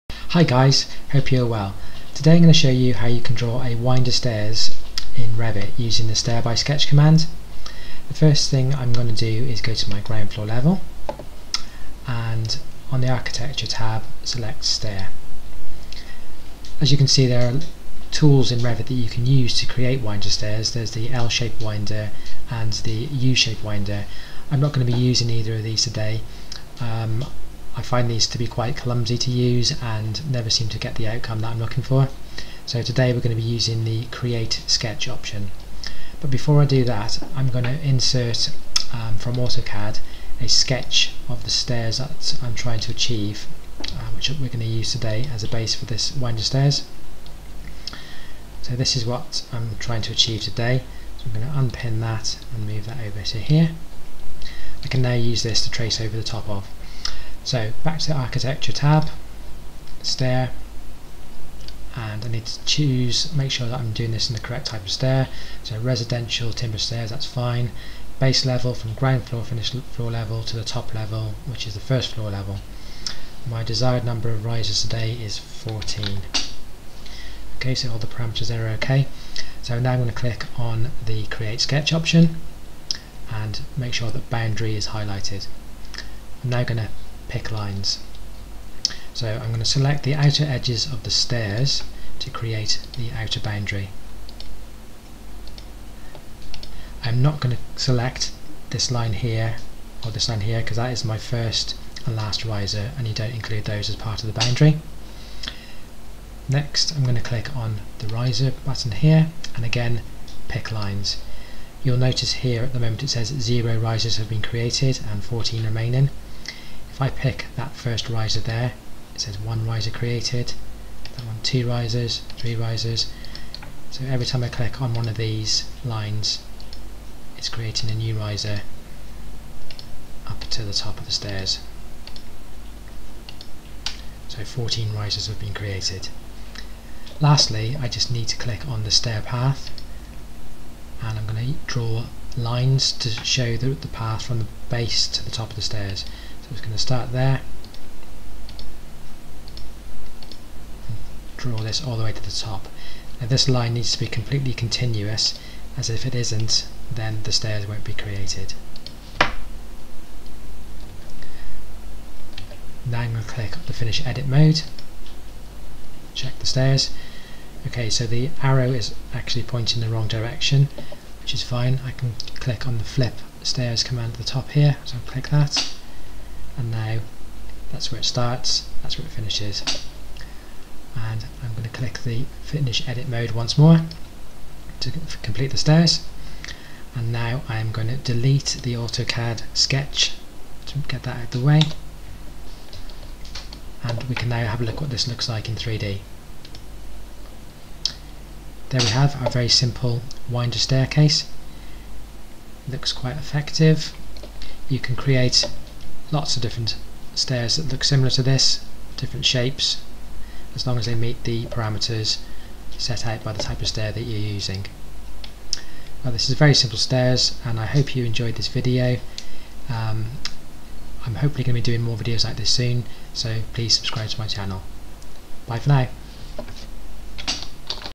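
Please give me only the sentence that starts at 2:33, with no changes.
Now this line needs to be completely continuous as if it isn't then the stairs won't be created.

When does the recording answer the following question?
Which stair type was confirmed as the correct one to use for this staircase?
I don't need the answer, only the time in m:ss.
1:05.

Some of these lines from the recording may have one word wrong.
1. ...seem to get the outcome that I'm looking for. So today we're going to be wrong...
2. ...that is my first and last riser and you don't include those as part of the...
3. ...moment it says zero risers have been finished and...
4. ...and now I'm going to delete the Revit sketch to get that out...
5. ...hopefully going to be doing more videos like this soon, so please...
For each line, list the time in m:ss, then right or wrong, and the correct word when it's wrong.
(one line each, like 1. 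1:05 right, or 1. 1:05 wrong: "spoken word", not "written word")
1. 0:30 wrong: "using", not "wrong"
2. 1:40 right
3. 1:52 wrong: "created", not "finished"
4. 3:06 wrong: "AutoCAD", not "Revit"
5. 3:41 right.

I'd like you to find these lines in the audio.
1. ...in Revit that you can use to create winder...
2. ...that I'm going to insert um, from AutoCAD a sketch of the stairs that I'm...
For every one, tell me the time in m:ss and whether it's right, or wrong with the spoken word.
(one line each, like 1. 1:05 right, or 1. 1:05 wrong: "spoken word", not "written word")
1. 0:18 right
2. 0:36 right.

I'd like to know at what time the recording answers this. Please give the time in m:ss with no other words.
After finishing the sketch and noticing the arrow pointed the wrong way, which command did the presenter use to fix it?
2:52.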